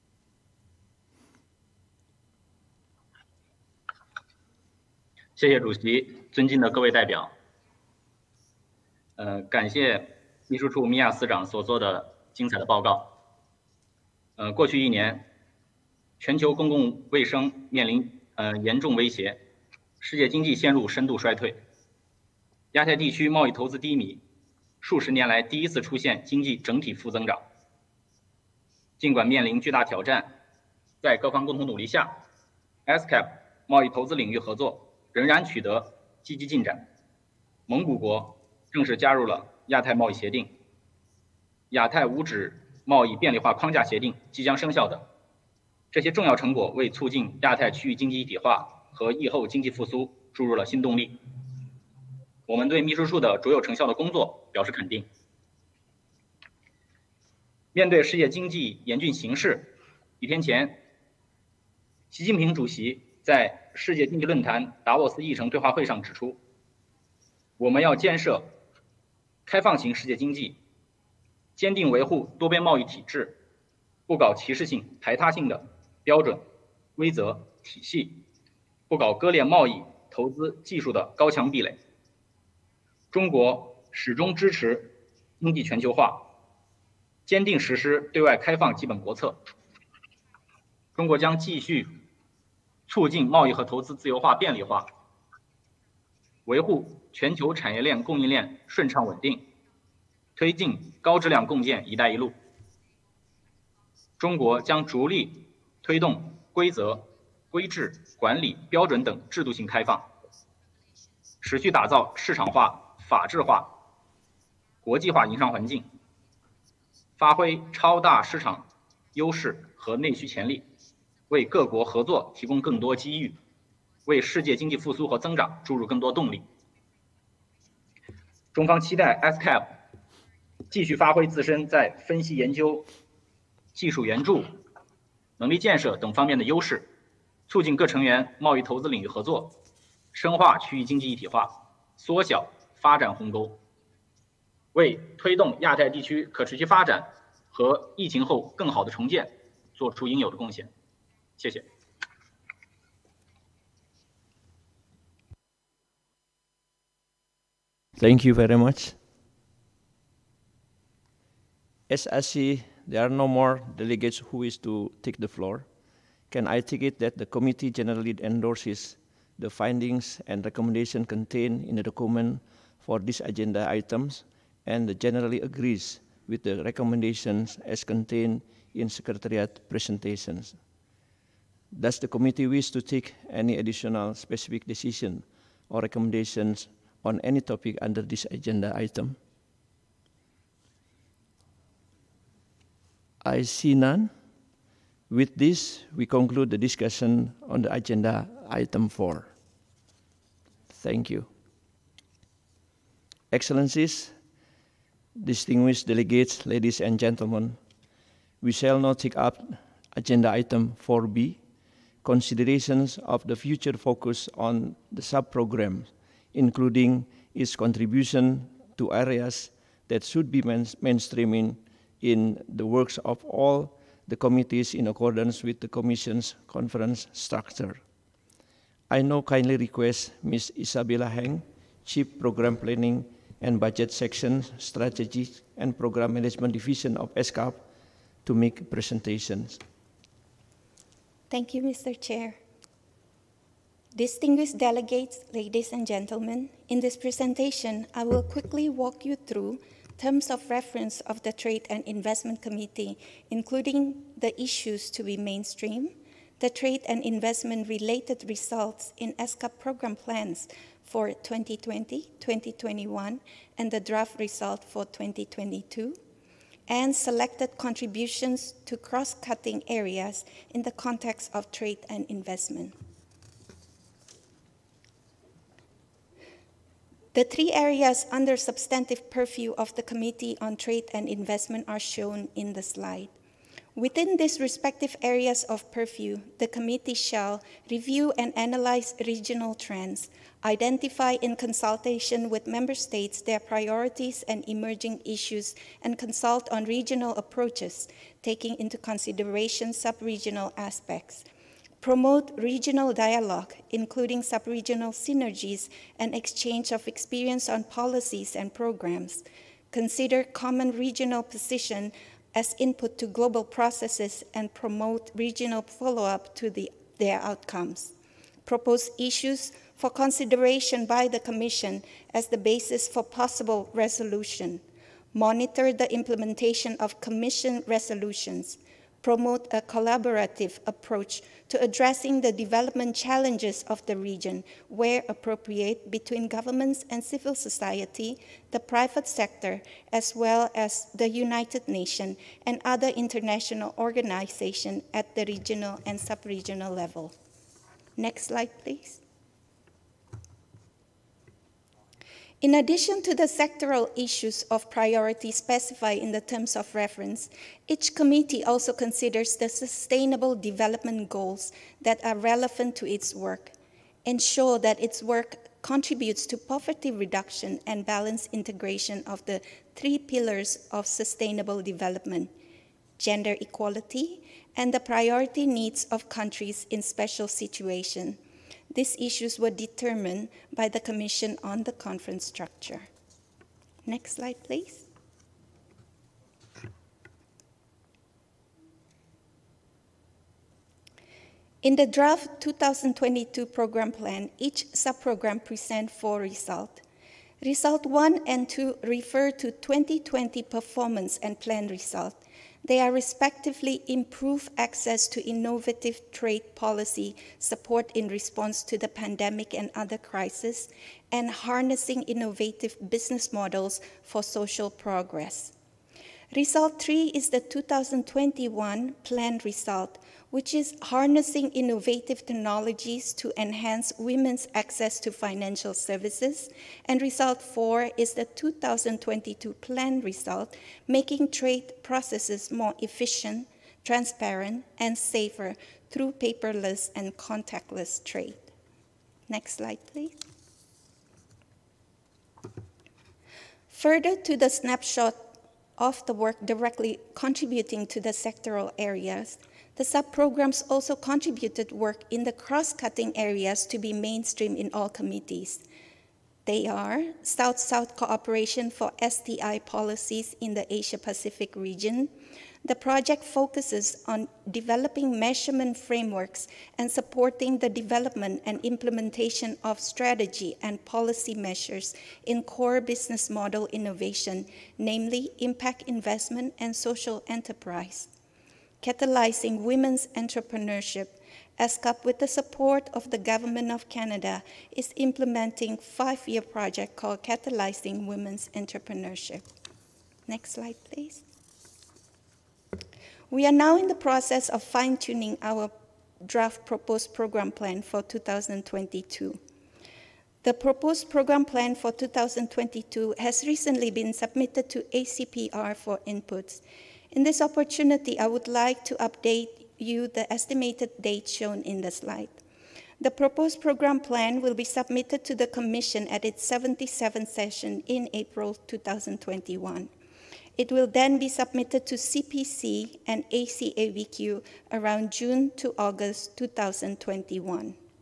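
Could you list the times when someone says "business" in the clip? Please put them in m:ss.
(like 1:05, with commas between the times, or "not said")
6:52, 7:52.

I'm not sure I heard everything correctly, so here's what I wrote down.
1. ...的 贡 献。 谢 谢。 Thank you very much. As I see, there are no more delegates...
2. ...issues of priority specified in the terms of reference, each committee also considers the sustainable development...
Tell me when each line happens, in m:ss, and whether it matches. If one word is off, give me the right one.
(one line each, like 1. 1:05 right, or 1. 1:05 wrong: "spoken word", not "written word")
1. 2:30 right
2. 5:53 right.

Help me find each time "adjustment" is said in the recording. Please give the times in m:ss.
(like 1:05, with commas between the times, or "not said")
not said.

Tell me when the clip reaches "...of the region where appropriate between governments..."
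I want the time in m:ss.
5:33.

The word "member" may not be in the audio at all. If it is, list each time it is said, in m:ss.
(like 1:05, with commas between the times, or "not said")
4:52.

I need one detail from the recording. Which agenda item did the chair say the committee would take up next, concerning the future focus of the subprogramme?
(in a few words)
4B.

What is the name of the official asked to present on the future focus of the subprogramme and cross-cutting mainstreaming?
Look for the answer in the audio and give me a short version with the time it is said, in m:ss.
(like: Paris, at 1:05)
Isabella Heng, at 3:50.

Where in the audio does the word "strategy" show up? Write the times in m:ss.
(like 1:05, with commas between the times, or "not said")
3:54, 7:49.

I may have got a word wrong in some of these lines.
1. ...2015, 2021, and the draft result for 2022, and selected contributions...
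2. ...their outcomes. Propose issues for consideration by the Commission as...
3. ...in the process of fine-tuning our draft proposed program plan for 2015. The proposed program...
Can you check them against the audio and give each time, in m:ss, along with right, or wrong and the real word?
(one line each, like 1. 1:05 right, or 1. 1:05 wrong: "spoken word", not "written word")
1. 4:21 wrong: "2020", not "2015"
2. 5:16 right
3. 8:13 wrong: "2022", not "2015".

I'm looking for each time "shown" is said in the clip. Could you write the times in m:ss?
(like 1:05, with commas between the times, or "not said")
4:41, 8:31.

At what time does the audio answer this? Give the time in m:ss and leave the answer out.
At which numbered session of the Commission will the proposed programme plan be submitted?
8:36.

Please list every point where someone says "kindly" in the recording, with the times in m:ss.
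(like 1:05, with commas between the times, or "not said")
3:49.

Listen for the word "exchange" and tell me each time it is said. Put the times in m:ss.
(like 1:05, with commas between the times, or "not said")
5:06.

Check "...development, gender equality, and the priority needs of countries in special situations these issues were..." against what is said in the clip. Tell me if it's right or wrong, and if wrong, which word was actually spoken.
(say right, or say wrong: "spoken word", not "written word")
right.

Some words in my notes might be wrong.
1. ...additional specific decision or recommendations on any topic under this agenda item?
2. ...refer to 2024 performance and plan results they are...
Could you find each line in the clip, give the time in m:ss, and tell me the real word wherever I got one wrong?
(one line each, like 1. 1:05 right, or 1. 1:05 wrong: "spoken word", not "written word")
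1. 3:03 right
2. 6:38 wrong: "2020", not "2024".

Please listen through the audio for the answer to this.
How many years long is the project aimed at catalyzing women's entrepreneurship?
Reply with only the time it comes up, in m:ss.
8:05.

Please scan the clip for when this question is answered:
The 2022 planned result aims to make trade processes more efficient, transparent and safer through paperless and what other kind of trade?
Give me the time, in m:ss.
7:17.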